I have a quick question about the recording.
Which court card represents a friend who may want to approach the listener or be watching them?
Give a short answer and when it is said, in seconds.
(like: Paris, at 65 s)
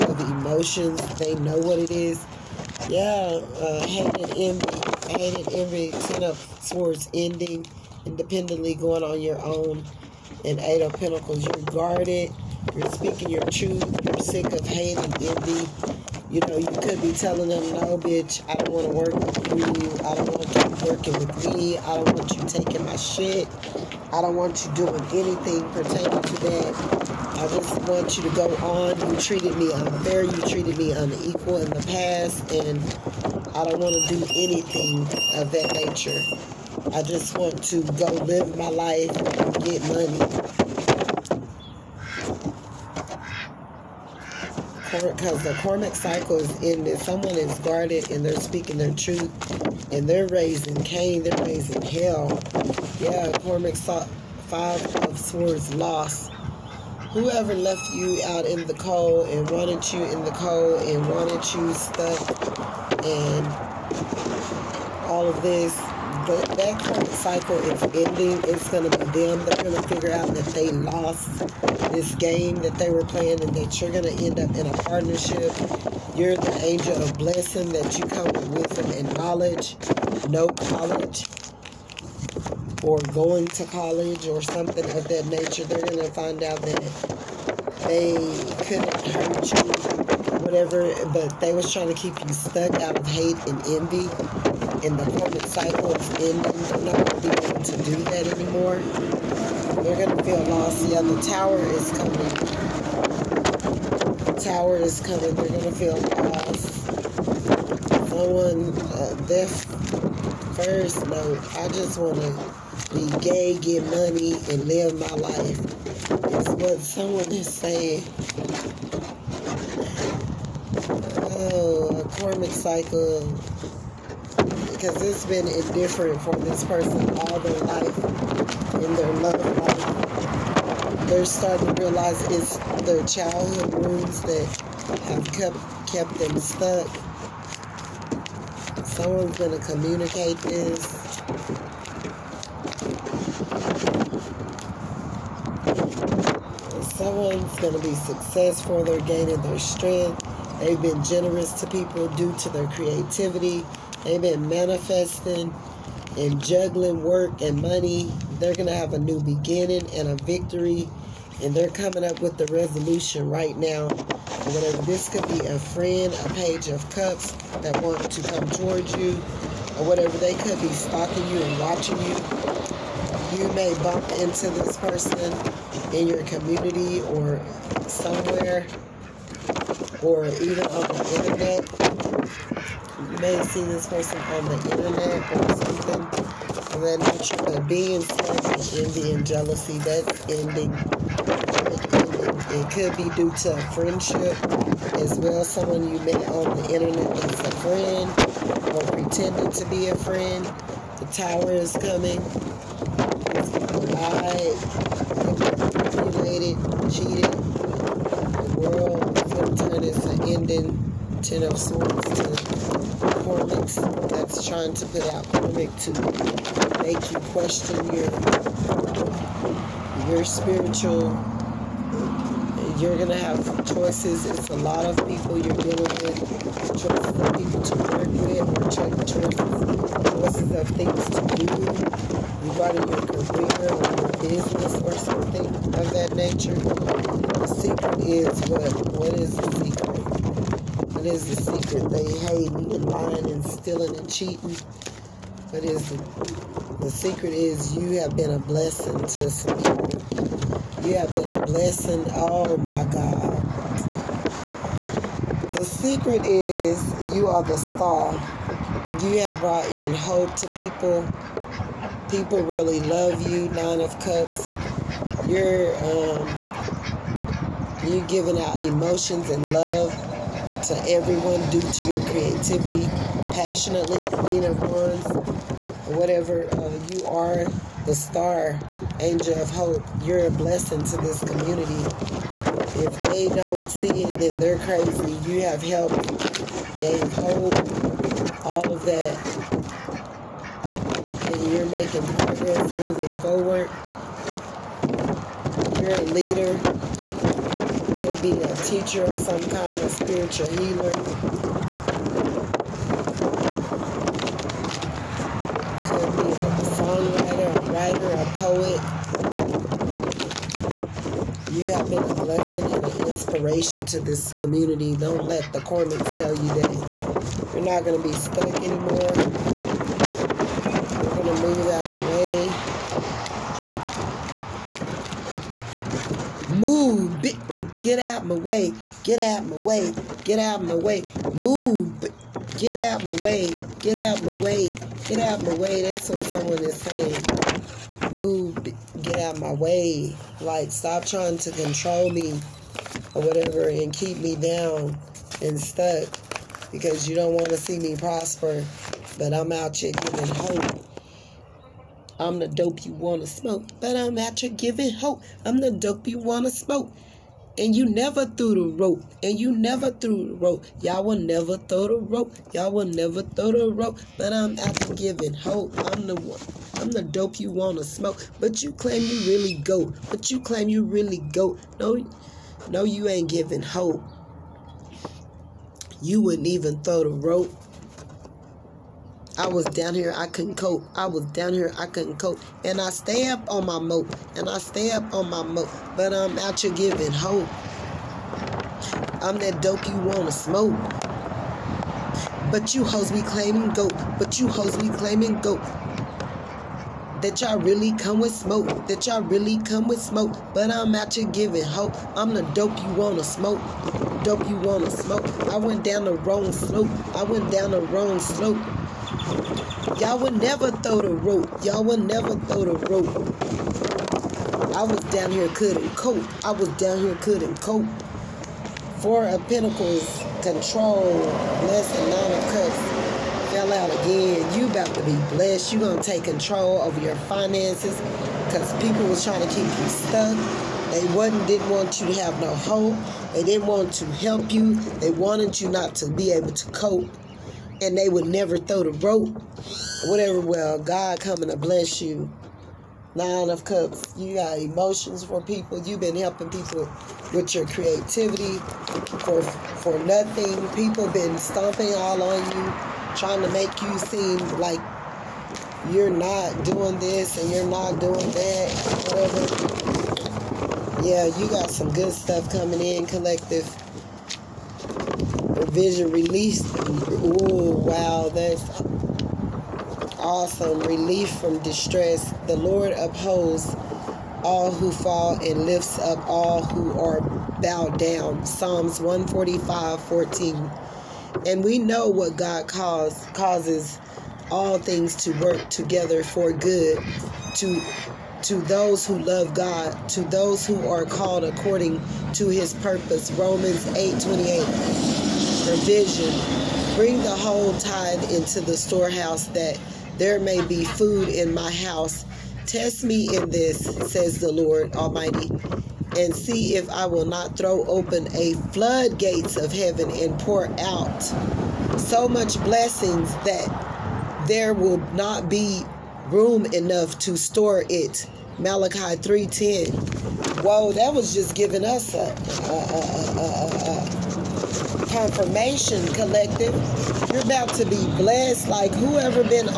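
Page of Cups, at 166 s.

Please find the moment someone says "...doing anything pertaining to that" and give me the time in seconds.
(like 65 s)
24 s.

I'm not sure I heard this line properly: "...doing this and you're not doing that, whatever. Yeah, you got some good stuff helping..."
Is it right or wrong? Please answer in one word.
wrong.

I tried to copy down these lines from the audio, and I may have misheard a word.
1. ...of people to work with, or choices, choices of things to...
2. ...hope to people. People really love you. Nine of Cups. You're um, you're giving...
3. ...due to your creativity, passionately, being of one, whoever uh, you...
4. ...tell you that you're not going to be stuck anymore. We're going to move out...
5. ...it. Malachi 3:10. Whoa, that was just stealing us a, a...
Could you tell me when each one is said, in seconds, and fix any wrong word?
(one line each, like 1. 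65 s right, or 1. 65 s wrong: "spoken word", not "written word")
1. 227 s right
2. 259 s right
3. 271 s wrong: "whatever", not "whoever"
4. 316 s right
5. 517 s wrong: "giving", not "stealing".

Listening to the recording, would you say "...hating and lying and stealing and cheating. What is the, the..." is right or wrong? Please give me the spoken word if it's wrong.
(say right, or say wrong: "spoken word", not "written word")
right.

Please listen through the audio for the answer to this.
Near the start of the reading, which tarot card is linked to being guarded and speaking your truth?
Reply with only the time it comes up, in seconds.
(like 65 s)
10 s.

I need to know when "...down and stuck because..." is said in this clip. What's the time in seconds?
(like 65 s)
344 s.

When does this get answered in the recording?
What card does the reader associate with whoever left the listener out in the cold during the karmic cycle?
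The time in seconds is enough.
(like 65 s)
53 s.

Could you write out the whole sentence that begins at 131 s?
They're starting to realize it's their childhood wounds that have kept, kept them stuck.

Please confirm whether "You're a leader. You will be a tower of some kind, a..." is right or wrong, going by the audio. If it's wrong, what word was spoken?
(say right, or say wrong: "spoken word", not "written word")
wrong: "teacher", not "tower".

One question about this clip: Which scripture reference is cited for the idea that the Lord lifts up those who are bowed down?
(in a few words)
Psalms 145:14.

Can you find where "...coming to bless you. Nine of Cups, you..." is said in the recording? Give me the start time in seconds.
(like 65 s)
441 s.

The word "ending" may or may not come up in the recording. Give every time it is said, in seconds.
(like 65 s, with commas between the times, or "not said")
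7 s, 67 s, 96 s, 190 s, 210 s.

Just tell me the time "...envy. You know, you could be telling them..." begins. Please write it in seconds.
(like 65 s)
15 s.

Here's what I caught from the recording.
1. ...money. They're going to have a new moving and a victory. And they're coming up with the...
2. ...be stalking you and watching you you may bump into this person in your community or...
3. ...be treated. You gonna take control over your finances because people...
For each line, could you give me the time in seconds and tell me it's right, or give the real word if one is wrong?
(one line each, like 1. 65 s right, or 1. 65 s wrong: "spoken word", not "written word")
1. 157 s wrong: "beginning", not "moving"
2. 170 s right
3. 425 s wrong: "blessed", not "treated".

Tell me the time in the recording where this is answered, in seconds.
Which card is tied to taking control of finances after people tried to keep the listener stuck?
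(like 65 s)
418 s.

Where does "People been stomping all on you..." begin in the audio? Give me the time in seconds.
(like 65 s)
450 s.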